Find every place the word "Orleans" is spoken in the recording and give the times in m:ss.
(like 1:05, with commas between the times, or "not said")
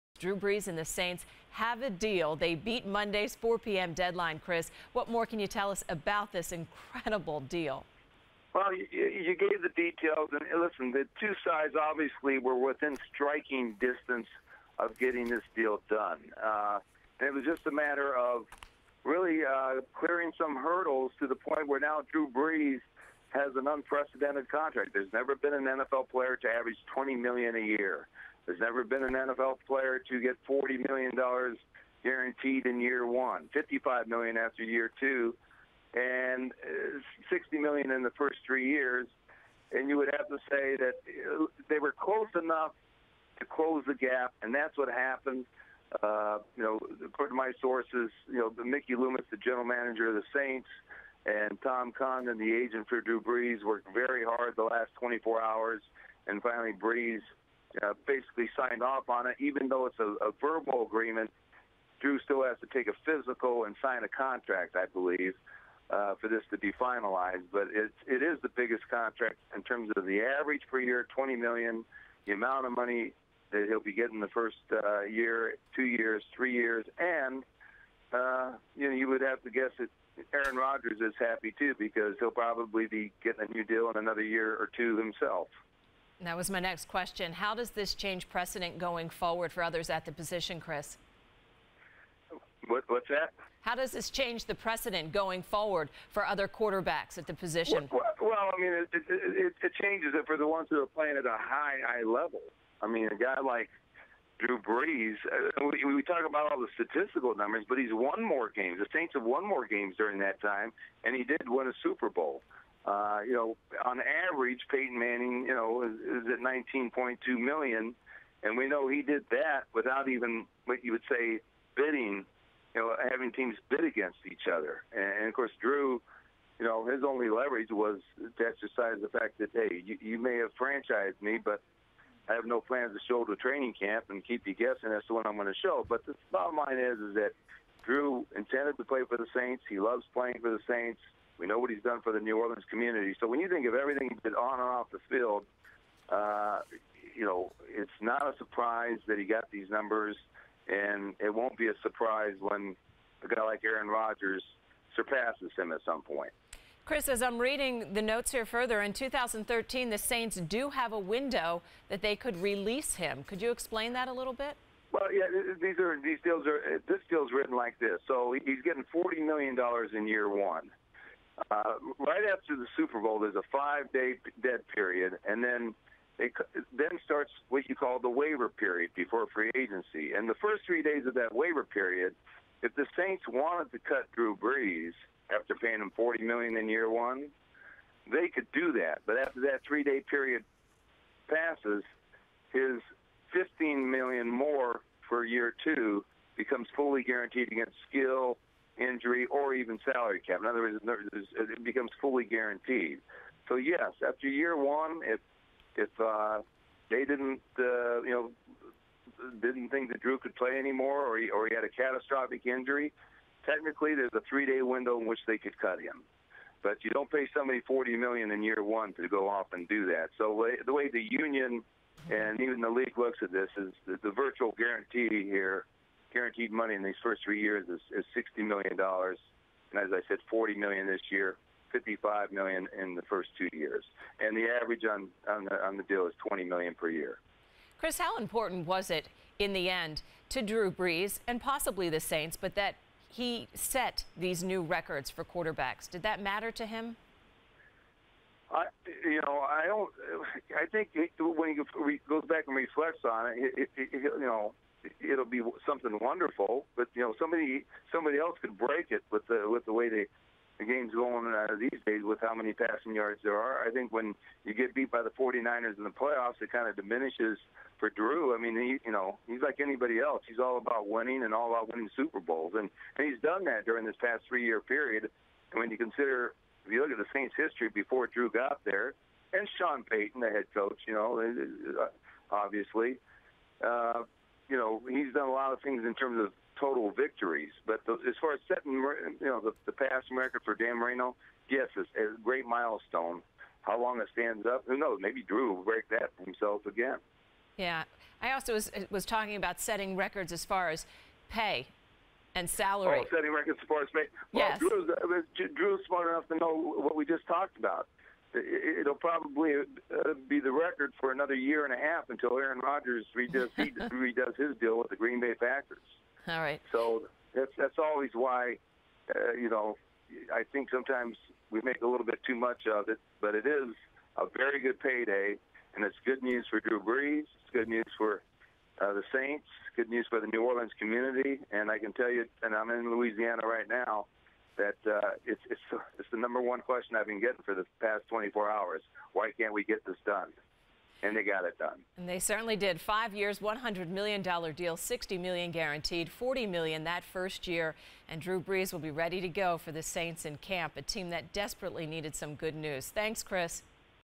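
2:22, 5:30.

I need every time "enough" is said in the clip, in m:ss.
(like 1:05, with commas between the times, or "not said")
0:42, 5:06.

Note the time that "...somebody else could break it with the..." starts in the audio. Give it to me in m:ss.
4:17.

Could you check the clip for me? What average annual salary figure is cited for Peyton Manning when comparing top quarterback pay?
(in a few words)
19.2 million.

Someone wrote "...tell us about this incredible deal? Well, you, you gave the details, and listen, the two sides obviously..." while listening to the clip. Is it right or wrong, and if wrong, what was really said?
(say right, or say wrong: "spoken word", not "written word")
right.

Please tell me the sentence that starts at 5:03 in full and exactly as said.
Oh, setting records as far as pay.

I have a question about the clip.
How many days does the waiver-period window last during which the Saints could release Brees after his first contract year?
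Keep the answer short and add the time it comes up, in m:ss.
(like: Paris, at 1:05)
3, at 3:00.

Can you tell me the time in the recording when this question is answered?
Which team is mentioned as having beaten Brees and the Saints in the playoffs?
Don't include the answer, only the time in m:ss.
4:25.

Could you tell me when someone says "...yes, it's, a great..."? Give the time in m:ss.
4:51.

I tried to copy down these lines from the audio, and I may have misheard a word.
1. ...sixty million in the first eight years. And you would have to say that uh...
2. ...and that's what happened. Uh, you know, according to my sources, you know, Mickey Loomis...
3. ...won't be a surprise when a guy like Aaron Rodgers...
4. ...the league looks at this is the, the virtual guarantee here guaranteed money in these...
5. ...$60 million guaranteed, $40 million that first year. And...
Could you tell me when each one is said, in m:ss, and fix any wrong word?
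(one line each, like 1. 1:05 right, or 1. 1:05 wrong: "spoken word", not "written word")
1. 0:37 wrong: "three", not "eight"
2. 0:44 right
3. 2:31 right
4. 3:42 right
5. 5:44 right.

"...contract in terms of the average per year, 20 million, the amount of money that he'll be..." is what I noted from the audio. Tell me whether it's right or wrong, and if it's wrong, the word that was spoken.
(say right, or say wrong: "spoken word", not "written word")
right.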